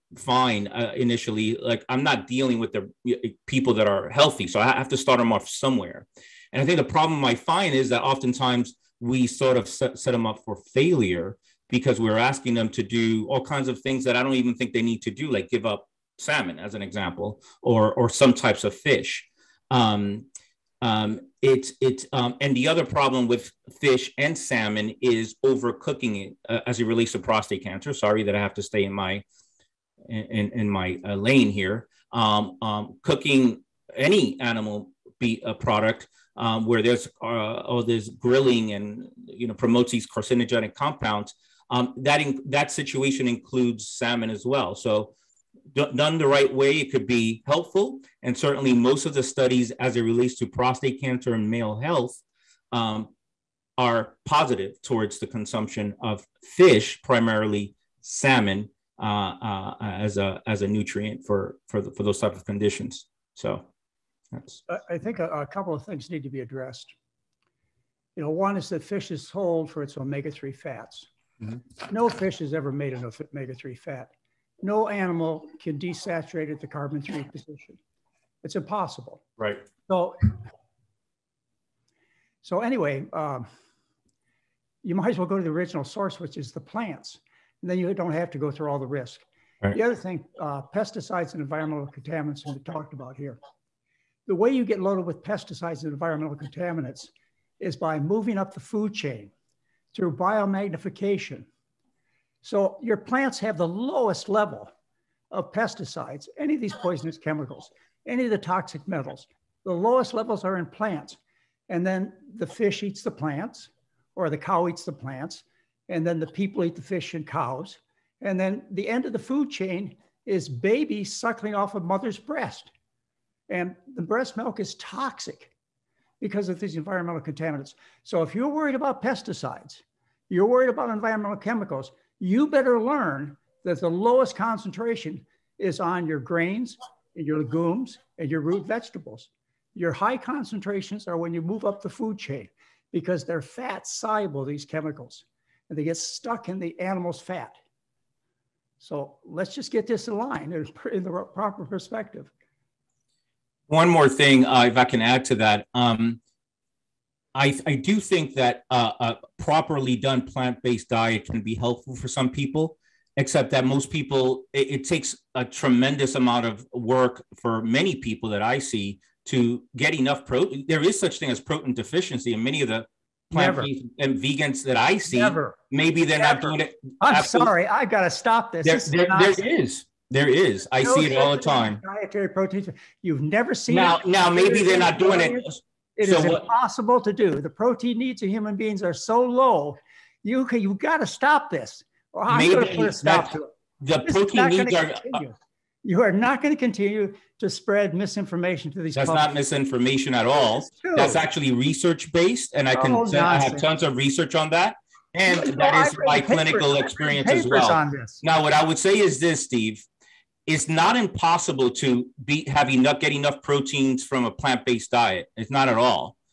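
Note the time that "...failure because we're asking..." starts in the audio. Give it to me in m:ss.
0:10.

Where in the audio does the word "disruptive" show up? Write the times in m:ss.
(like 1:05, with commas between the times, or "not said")
not said.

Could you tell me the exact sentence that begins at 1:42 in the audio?
So your plants have the lowest level of pesticides, any of these poisonous chemicals, any of the toxic metals.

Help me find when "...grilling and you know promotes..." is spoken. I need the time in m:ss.
0:38.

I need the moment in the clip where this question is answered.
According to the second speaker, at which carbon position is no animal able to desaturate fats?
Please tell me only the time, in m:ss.
1:16.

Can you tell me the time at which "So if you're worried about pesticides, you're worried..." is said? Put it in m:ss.
2:08.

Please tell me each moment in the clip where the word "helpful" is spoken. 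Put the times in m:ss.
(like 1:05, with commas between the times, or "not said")
0:47, 2:41.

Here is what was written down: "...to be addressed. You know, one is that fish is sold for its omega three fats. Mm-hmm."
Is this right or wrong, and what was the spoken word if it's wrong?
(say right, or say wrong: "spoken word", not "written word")
right.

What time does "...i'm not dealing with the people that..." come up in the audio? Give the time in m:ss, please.
0:01.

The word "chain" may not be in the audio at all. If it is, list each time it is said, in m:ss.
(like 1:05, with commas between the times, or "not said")
1:38, 1:59, 2:22.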